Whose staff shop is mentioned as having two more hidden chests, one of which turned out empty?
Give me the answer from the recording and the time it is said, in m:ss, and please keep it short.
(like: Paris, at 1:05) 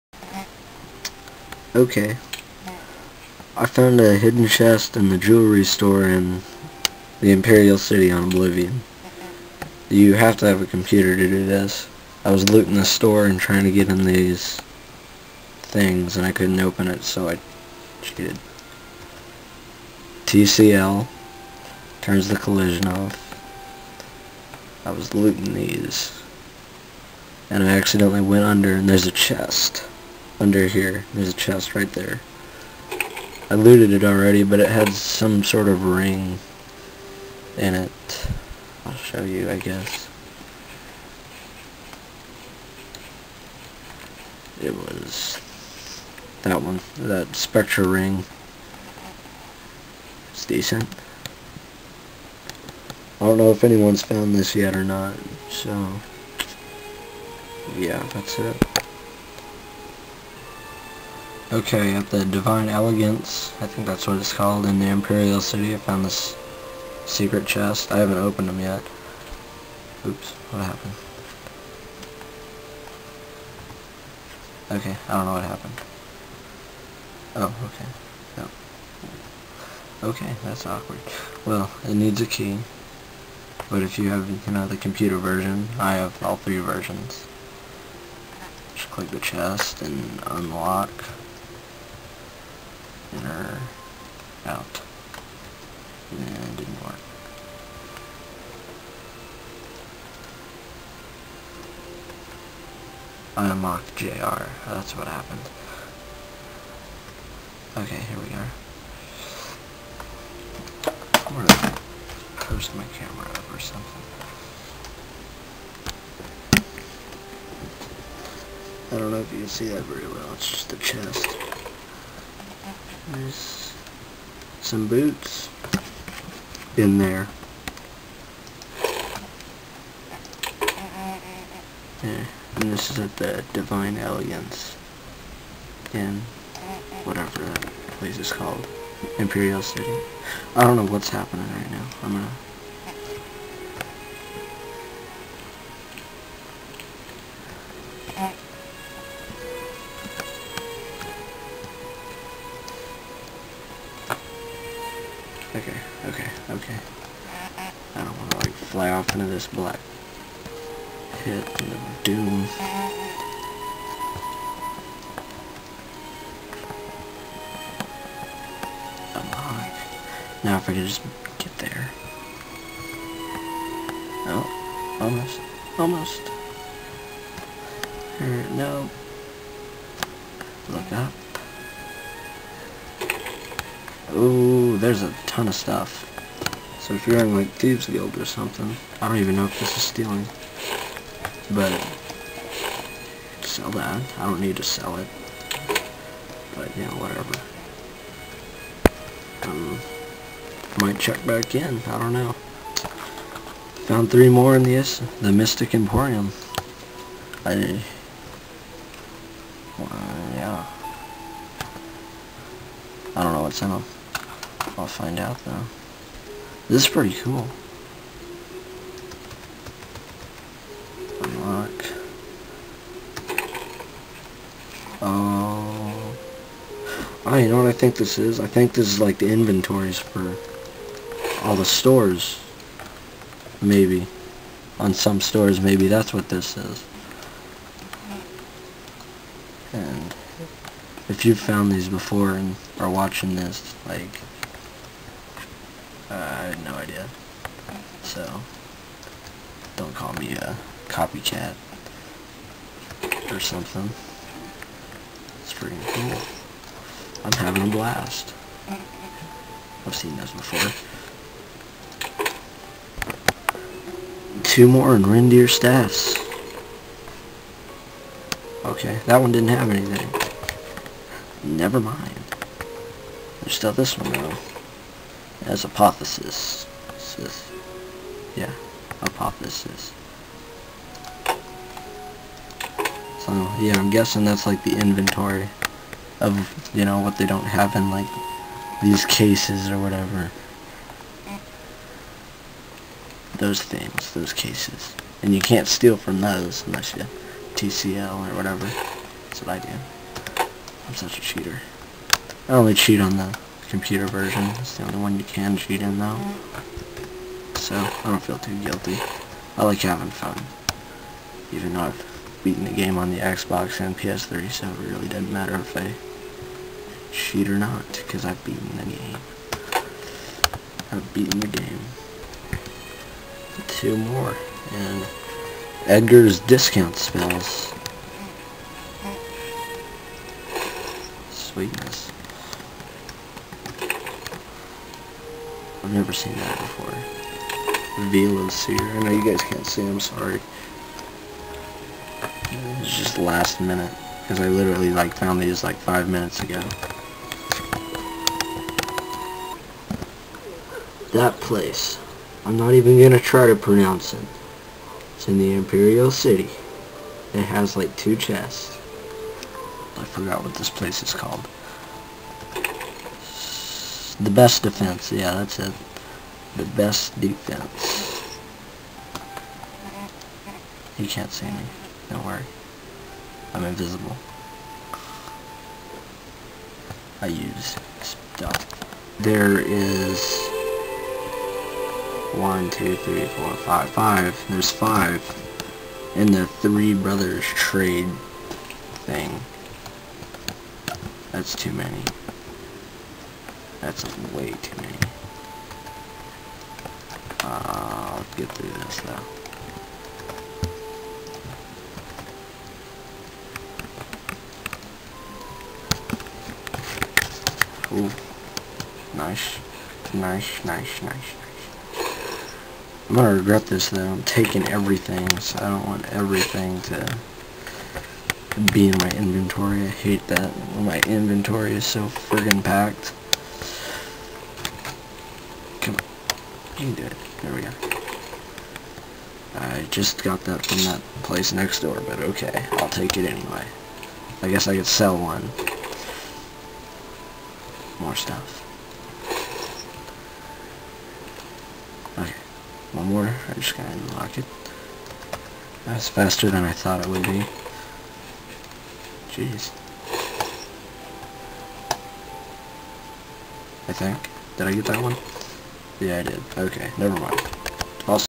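Rindir, at 4:25.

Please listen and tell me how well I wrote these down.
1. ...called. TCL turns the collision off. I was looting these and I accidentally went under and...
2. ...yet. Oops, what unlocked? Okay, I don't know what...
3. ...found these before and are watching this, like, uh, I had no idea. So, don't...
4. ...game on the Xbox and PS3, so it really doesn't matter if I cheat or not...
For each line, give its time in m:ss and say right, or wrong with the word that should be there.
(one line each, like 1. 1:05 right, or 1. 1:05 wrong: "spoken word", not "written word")
1. 0:18 wrong: "cheated", not "called"
2. 1:08 wrong: "happened", not "unlocked"
3. 4:01 right
4. 5:12 right.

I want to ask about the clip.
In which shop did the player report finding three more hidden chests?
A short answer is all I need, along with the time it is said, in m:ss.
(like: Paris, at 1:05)
Mystic Emporium, at 3:25.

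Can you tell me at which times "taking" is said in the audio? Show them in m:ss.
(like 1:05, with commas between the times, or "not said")
6:54.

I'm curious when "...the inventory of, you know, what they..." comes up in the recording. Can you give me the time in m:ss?
4:44.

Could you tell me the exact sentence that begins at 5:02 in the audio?
I only cheat on the computer version.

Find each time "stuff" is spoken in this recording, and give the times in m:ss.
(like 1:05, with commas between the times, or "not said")
3:05, 6:18, 7:18.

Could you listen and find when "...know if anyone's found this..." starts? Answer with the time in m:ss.
0:53.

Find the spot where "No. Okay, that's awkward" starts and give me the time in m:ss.
1:20.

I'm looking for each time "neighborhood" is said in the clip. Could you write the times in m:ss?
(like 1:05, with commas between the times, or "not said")
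not said.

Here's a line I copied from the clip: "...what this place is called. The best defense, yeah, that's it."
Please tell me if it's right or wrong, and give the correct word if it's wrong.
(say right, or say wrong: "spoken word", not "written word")
right.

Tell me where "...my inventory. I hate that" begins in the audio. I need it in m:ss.
6:58.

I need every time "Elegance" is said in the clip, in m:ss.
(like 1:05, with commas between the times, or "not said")
1:02, 2:13.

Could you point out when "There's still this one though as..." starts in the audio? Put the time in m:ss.
4:33.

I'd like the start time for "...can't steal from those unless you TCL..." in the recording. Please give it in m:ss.
4:55.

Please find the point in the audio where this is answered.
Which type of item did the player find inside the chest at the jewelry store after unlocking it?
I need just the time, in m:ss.
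2:04.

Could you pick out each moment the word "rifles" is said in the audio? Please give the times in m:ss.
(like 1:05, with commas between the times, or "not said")
not said.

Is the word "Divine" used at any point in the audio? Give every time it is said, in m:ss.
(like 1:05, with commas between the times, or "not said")
1:02, 2:13.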